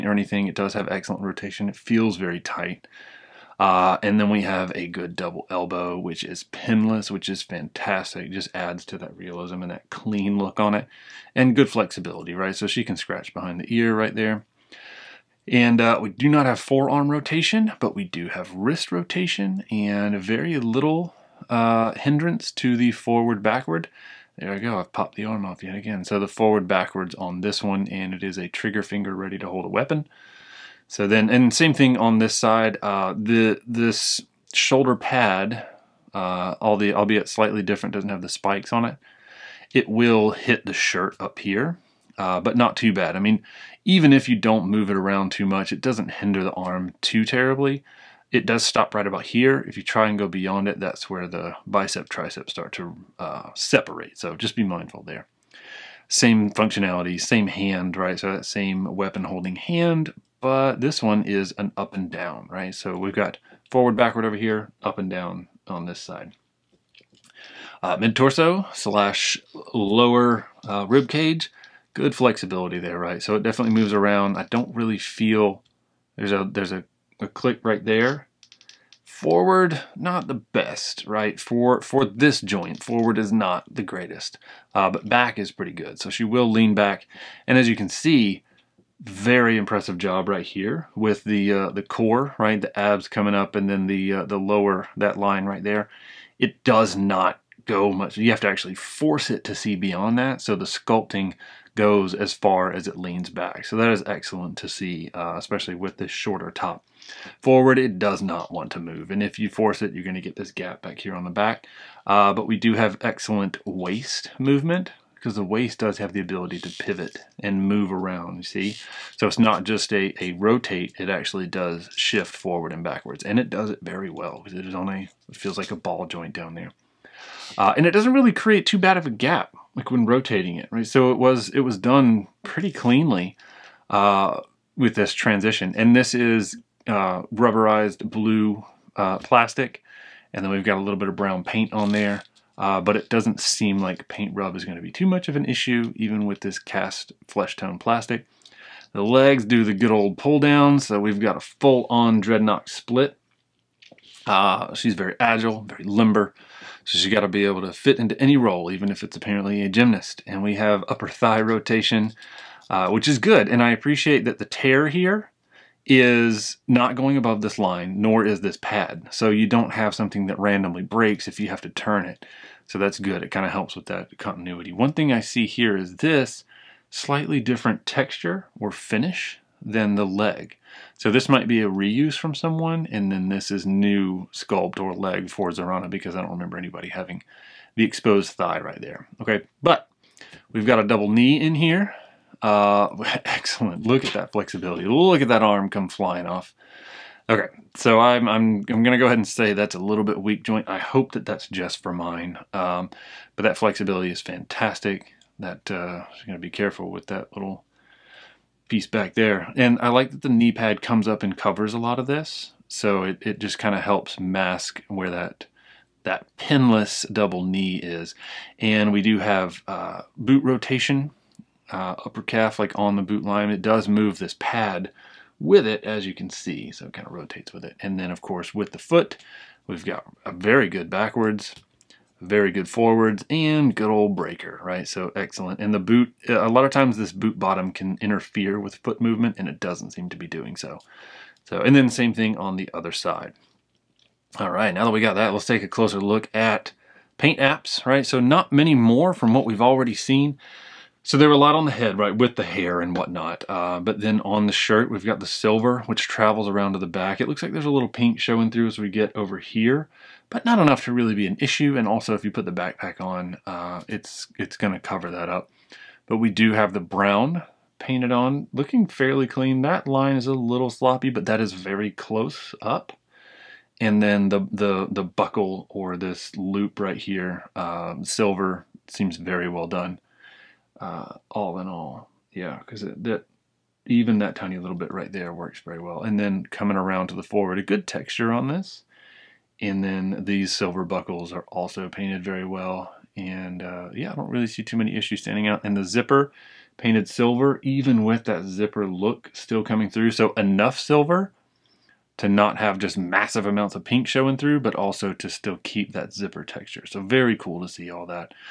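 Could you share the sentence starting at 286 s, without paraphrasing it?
And then coming around to the forward, a good texture on this.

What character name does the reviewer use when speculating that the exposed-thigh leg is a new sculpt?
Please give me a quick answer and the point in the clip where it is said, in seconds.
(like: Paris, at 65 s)
Zarana, at 185 s.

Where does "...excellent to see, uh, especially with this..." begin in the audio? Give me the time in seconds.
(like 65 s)
104 s.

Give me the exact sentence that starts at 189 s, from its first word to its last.
Okay, but we've got a double knee in here.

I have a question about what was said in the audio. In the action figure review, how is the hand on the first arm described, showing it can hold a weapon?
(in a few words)
Trigger finger.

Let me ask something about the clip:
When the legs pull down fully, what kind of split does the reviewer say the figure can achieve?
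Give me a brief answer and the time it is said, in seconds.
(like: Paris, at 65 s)
Dreadnok split, at 152 s.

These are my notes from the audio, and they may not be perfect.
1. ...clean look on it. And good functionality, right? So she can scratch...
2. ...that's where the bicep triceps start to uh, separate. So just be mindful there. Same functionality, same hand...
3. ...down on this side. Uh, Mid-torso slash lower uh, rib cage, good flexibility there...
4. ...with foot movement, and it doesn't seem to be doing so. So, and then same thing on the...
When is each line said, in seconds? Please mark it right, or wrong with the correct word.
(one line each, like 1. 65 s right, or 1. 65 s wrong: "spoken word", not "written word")
1. 9 s wrong: "flexibility", not "functionality"
2. 50 s right
3. 65 s right
4. 238 s right.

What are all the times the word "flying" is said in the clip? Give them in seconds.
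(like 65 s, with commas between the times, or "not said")
195 s.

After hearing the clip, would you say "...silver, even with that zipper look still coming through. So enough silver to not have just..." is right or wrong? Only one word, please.
right.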